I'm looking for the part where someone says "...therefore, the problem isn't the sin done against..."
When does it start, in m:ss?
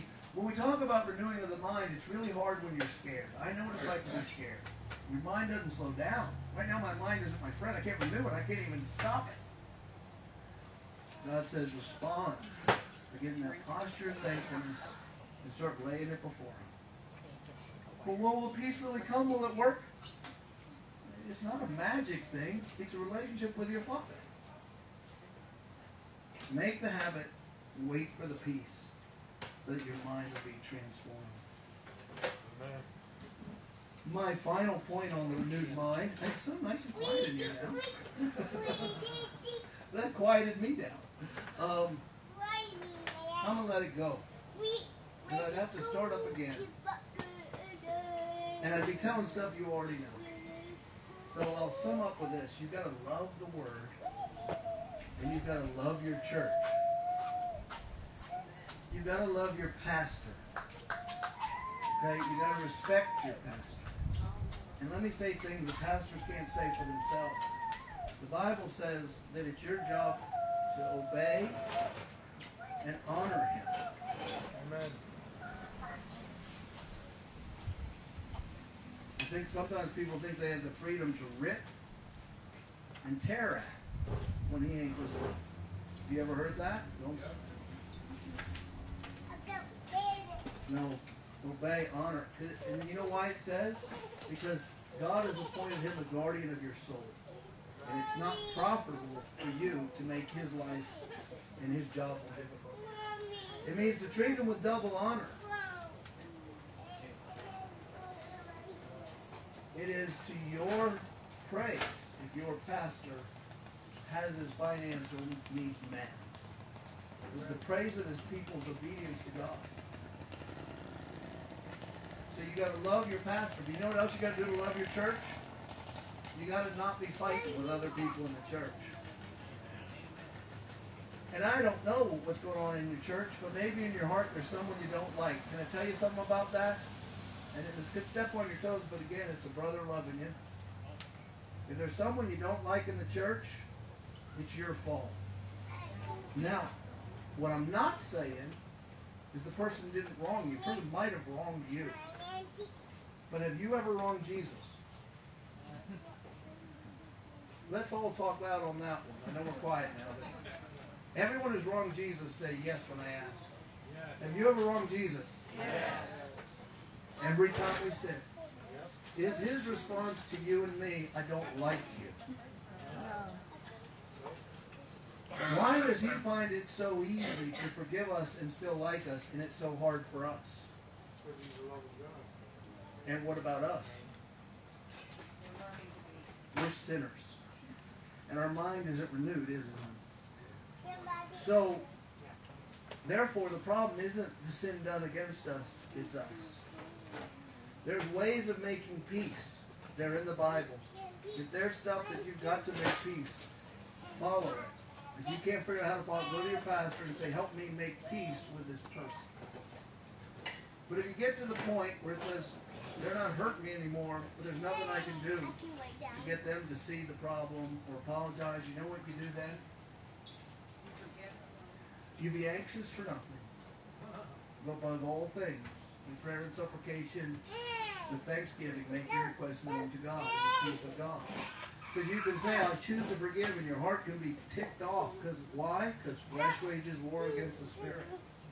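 3:13.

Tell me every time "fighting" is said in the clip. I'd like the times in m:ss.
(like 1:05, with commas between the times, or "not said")
2:07.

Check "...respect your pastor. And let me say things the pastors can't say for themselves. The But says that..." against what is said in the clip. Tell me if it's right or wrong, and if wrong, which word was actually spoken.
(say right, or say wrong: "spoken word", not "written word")
wrong: "Bible", not "But".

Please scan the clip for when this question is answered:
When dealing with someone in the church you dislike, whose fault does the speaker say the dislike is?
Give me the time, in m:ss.
2:24.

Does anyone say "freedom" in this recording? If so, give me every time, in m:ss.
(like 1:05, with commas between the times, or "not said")
1:20.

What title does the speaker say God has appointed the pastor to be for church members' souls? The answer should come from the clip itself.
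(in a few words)
Guardian.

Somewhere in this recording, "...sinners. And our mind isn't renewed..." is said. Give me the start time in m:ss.
3:06.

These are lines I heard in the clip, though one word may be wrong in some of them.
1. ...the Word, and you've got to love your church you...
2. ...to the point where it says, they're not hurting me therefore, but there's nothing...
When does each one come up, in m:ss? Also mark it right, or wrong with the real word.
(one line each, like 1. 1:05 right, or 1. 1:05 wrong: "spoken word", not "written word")
1. 0:53 right
2. 3:31 wrong: "anymore", not "therefore".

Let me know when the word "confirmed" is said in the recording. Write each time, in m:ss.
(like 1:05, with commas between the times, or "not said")
not said.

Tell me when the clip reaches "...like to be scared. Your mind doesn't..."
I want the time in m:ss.
0:03.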